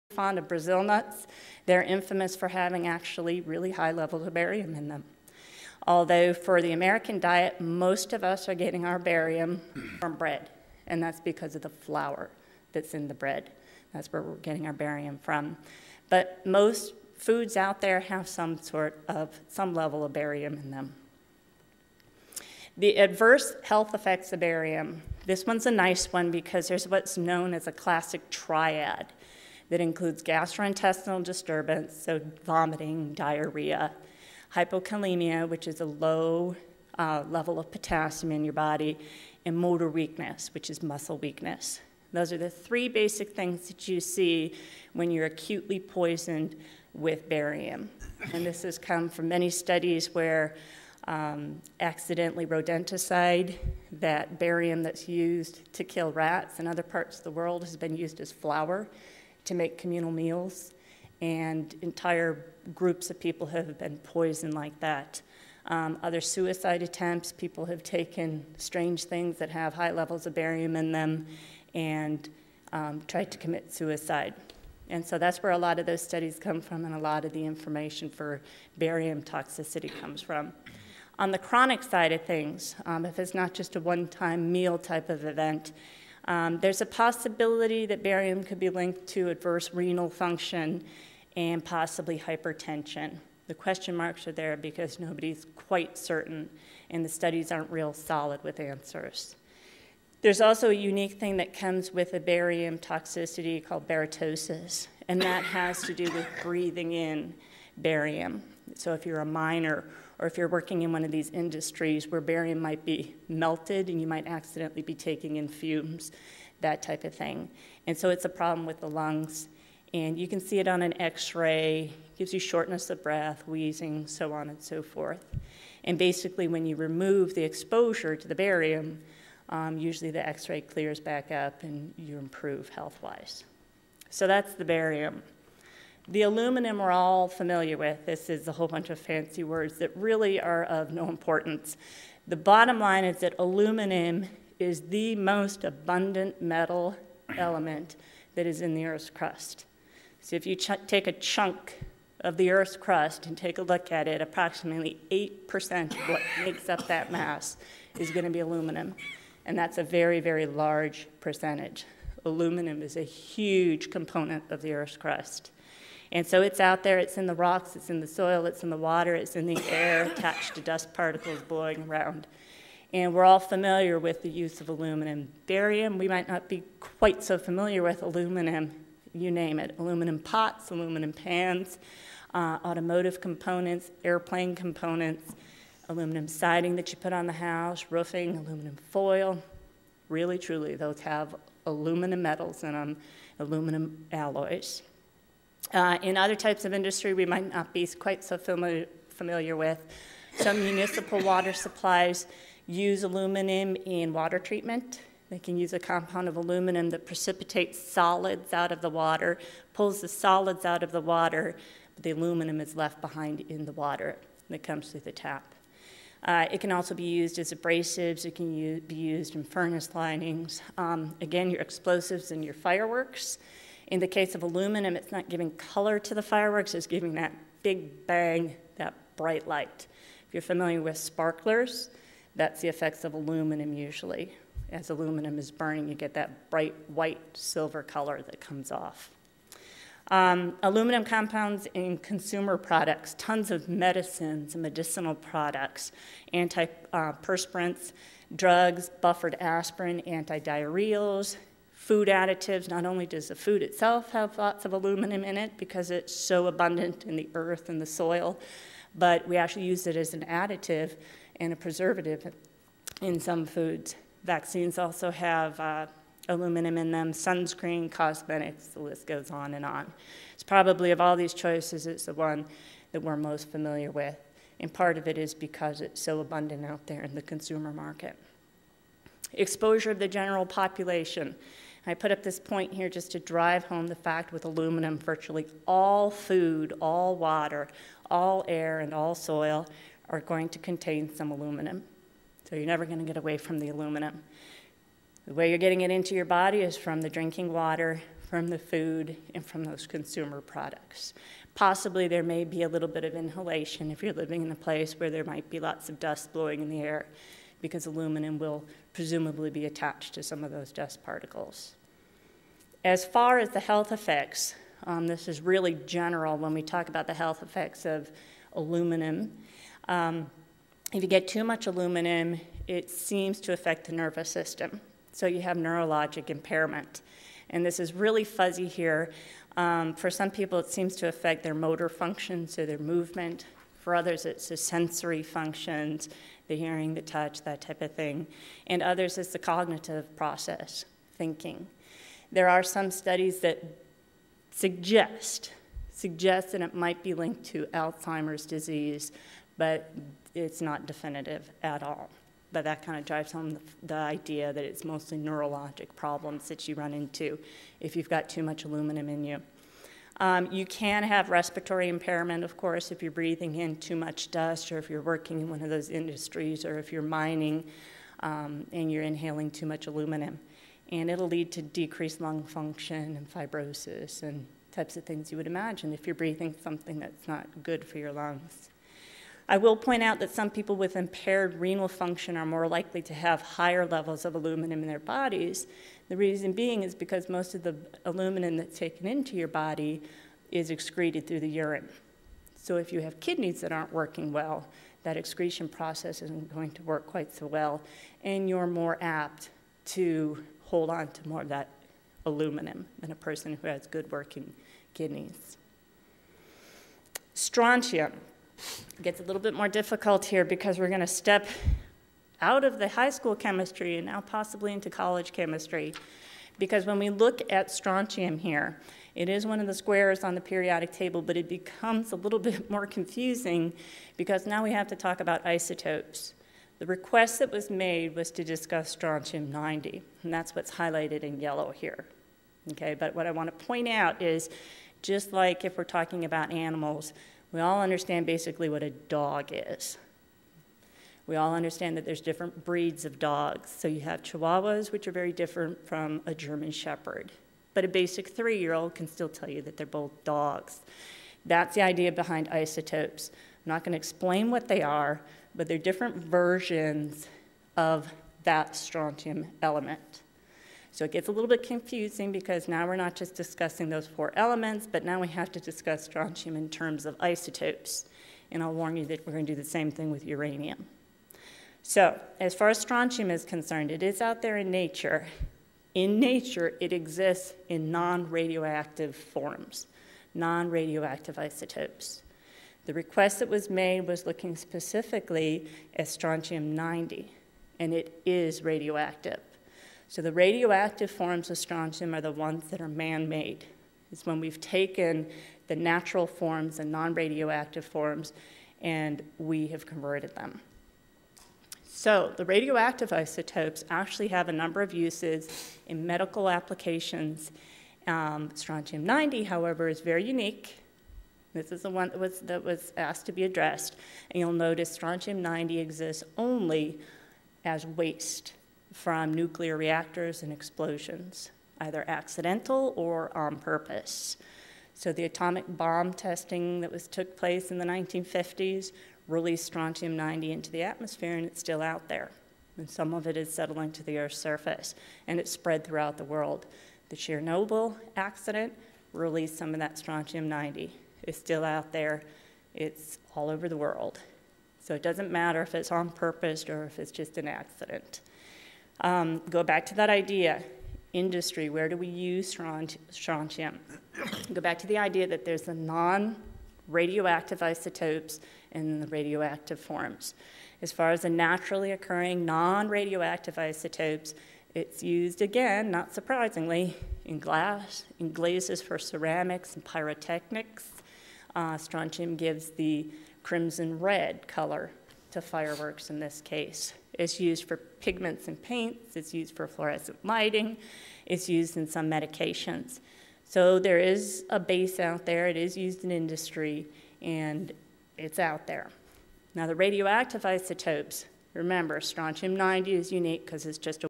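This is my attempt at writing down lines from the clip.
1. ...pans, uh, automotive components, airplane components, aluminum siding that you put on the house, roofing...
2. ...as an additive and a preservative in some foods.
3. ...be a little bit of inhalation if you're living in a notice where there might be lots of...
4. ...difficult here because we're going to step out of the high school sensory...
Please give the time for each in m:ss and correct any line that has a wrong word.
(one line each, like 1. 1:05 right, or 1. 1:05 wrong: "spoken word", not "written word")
1. 3:01 right
2. 4:19 right
3. 5:02 wrong: "place", not "notice"
4. 6:49 wrong: "chemistry", not "sensory".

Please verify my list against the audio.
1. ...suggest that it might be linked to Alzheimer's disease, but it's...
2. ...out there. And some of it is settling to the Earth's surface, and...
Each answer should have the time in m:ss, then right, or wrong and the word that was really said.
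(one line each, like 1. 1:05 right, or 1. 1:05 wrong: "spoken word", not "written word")
1. 5:45 right
2. 8:51 right.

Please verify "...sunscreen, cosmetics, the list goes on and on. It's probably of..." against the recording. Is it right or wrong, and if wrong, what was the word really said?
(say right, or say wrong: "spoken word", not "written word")
right.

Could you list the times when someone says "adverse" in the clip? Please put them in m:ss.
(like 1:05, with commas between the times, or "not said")
0:22, 1:29.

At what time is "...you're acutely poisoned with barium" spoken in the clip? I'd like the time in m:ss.
0:45.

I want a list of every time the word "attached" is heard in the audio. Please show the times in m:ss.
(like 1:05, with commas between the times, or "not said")
2:50, 5:09.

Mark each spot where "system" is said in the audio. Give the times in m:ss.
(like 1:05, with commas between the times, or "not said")
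5:24.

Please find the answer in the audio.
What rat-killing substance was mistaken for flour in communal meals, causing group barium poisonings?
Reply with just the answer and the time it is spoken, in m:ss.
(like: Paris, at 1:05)
rodenticide, at 0:52.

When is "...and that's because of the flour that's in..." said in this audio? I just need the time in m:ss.
0:10.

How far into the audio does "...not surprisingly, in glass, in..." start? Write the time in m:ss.
9:25.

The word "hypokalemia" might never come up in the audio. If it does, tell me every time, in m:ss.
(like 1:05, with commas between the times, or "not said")
0:34.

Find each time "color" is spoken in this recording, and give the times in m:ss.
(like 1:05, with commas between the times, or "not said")
3:45, 3:57, 9:34.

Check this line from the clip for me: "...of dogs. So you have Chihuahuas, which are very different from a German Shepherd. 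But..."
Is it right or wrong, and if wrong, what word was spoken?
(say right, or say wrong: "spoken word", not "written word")
right.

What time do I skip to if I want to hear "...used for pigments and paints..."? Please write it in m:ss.
9:37.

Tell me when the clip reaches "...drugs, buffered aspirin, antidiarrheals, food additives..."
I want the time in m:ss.
4:08.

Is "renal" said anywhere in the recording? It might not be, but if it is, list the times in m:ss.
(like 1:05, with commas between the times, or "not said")
1:29, 6:21.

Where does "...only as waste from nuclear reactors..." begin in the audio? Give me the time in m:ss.
8:36.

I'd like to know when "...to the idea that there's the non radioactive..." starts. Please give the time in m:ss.
9:14.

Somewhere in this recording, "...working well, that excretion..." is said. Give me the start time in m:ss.
6:33.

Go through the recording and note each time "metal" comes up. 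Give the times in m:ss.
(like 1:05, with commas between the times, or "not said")
2:26, 3:12.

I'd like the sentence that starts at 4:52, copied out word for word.
So you're never going to get away from the aluminum.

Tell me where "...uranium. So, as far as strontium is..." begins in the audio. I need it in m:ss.
7:50.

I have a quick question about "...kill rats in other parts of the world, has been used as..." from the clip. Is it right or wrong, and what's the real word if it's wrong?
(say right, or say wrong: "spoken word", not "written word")
right.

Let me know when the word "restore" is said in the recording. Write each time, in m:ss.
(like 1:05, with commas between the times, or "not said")
not said.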